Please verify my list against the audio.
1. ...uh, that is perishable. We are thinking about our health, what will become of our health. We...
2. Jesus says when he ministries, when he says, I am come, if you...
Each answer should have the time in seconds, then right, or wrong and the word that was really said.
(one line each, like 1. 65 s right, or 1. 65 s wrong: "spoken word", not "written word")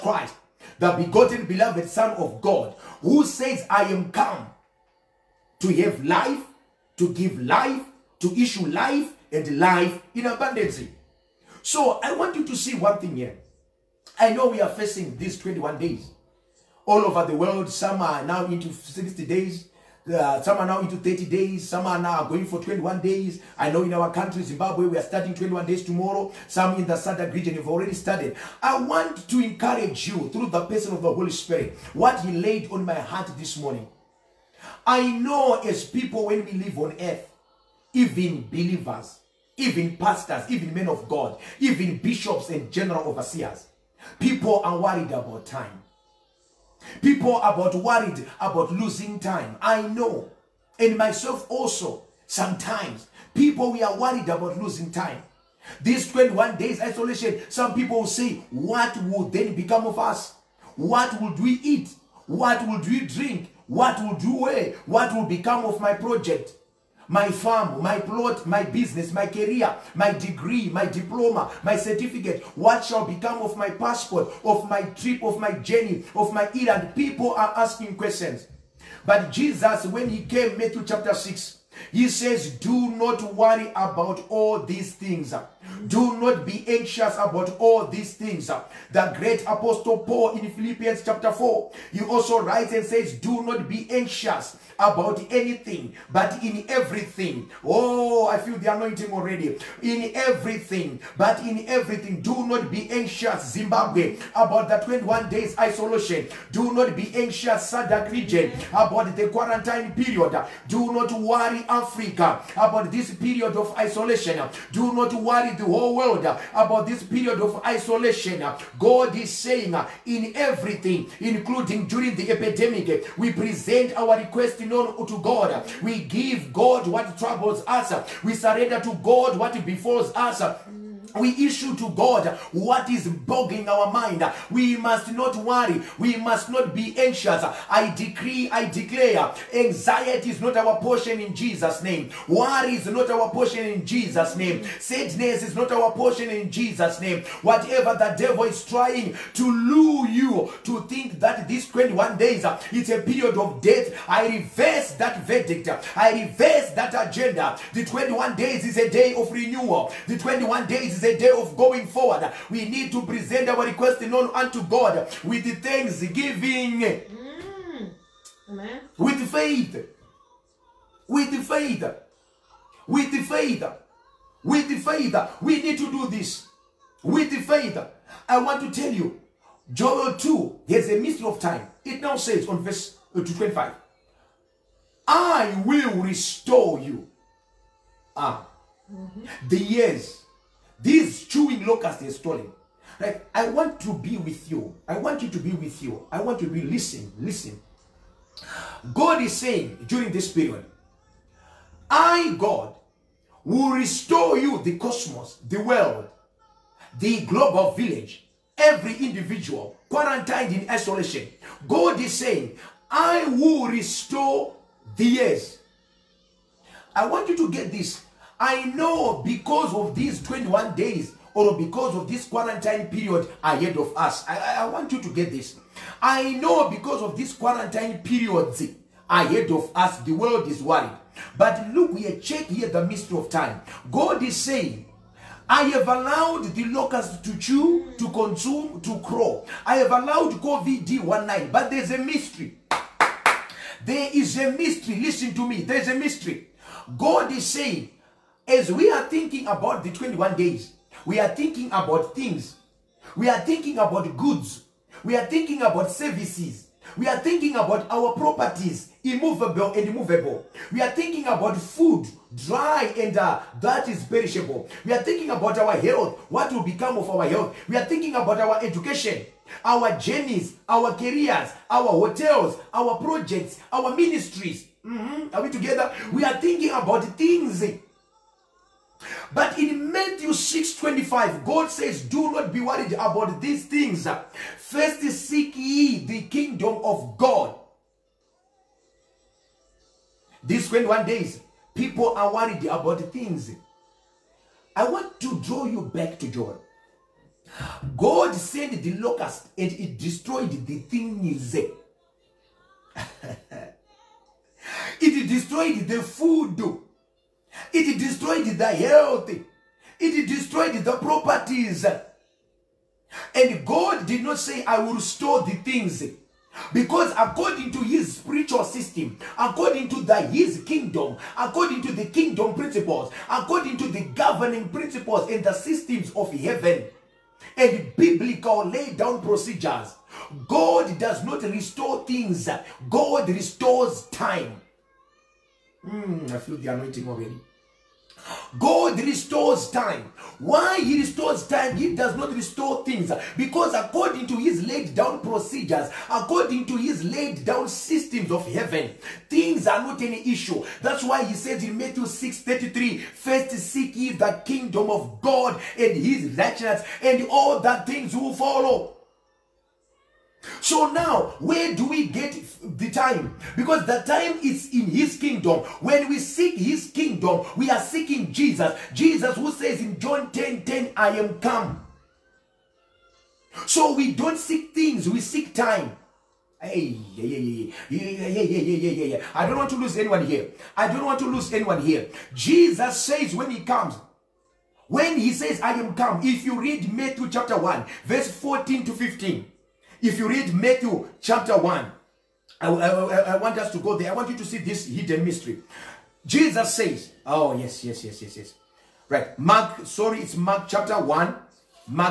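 1. 263 s right
2. 382 s wrong: "comes", not "ministries".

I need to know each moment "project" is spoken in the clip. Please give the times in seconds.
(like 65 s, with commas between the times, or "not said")
65 s, 272 s.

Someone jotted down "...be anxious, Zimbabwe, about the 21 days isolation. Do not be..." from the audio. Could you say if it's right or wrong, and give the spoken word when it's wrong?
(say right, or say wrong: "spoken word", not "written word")
right.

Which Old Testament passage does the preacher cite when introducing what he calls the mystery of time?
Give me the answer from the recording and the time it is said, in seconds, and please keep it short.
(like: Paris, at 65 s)
Joel 2, at 179 s.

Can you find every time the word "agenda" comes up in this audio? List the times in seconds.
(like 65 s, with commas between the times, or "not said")
157 s.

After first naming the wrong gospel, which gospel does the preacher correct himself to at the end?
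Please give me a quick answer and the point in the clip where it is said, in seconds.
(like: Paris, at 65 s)
Mark chapter 1, at 400 s.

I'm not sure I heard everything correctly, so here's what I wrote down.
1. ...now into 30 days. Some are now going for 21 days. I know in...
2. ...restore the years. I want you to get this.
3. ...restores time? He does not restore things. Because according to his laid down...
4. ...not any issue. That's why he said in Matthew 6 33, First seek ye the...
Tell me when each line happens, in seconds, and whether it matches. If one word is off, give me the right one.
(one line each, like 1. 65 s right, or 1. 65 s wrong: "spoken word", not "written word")
1. 20 s right
2. 213 s right
3. 340 s right
4. 349 s right.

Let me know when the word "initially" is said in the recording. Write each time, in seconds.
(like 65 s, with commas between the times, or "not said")
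not said.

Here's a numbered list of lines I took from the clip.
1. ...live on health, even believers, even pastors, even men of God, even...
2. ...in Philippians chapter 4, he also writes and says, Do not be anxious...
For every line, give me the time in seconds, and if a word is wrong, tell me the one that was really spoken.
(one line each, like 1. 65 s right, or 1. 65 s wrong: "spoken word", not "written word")
1. 36 s wrong: "earth", not "health"
2. 90 s right.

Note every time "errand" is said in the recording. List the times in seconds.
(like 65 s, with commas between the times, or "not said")
76 s.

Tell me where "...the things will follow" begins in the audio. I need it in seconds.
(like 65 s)
357 s.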